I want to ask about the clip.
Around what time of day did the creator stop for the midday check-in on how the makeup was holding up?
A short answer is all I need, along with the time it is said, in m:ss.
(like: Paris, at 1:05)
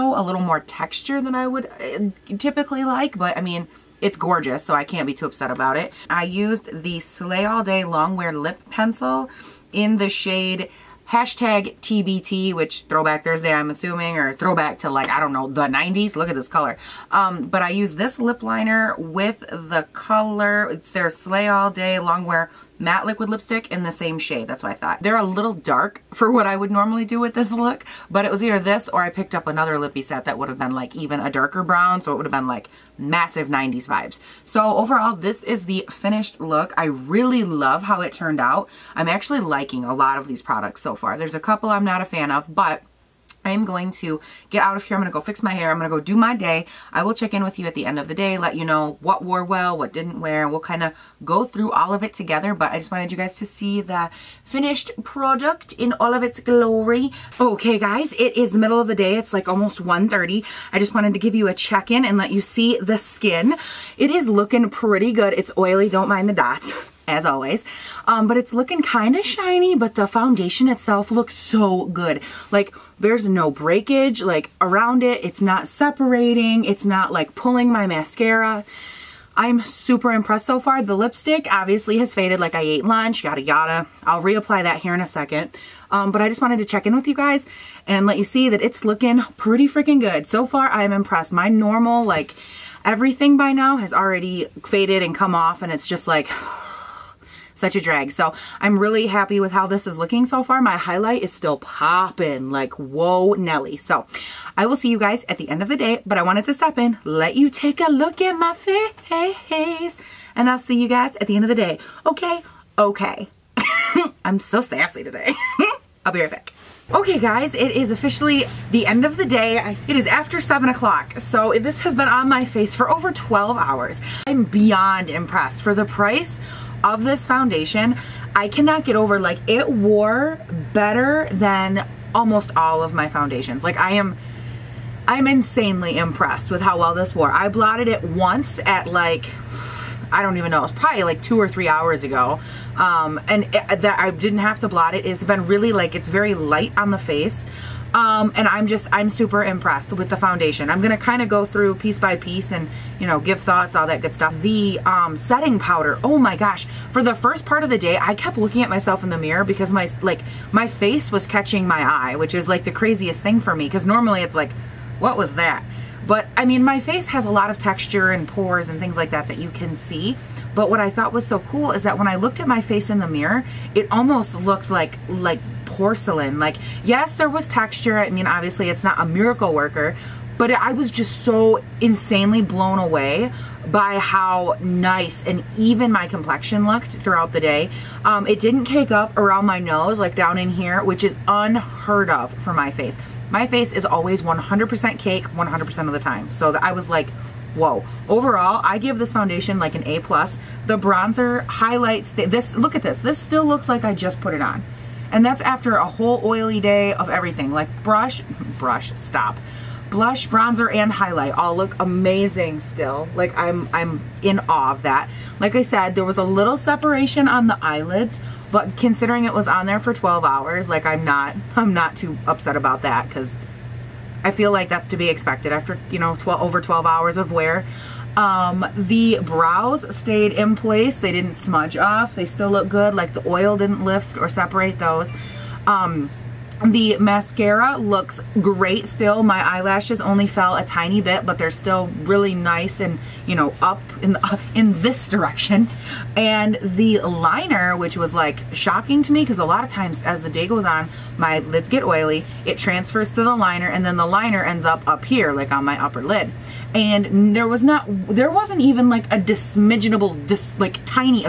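1:30, at 0:59.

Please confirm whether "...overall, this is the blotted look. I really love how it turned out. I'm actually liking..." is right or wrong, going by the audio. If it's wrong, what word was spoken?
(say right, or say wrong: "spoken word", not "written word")
wrong: "finished", not "blotted".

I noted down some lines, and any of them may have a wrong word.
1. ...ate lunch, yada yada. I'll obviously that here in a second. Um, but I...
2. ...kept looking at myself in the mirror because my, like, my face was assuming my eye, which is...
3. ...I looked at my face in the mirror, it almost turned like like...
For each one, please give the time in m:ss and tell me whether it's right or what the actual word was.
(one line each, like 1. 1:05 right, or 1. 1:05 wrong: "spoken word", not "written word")
1. 1:22 wrong: "reapply", not "obviously"
2. 2:38 wrong: "catching", not "assuming"
3. 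2:52 wrong: "looked", not "turned".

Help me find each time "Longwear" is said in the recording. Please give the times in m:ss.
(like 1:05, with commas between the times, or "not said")
0:07, 0:21.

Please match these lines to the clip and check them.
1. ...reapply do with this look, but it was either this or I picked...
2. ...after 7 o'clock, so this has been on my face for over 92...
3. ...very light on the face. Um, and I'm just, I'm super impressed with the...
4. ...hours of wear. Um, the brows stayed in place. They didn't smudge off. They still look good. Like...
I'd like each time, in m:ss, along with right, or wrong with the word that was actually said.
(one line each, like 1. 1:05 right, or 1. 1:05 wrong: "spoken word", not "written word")
1. 0:26 wrong: "normally", not "reapply"
2. 2:00 wrong: "12", not "92"
3. 2:26 right
4. 3:46 right.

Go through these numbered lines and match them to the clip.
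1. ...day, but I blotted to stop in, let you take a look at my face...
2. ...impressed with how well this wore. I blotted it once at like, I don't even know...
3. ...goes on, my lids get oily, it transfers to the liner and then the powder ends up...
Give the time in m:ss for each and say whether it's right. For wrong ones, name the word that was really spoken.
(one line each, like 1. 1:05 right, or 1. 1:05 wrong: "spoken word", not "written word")
1. 1:45 wrong: "wanted", not "blotted"
2. 2:15 right
3. 4:10 wrong: "liner", not "powder".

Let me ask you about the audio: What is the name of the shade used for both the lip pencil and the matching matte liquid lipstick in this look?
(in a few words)
#TBT.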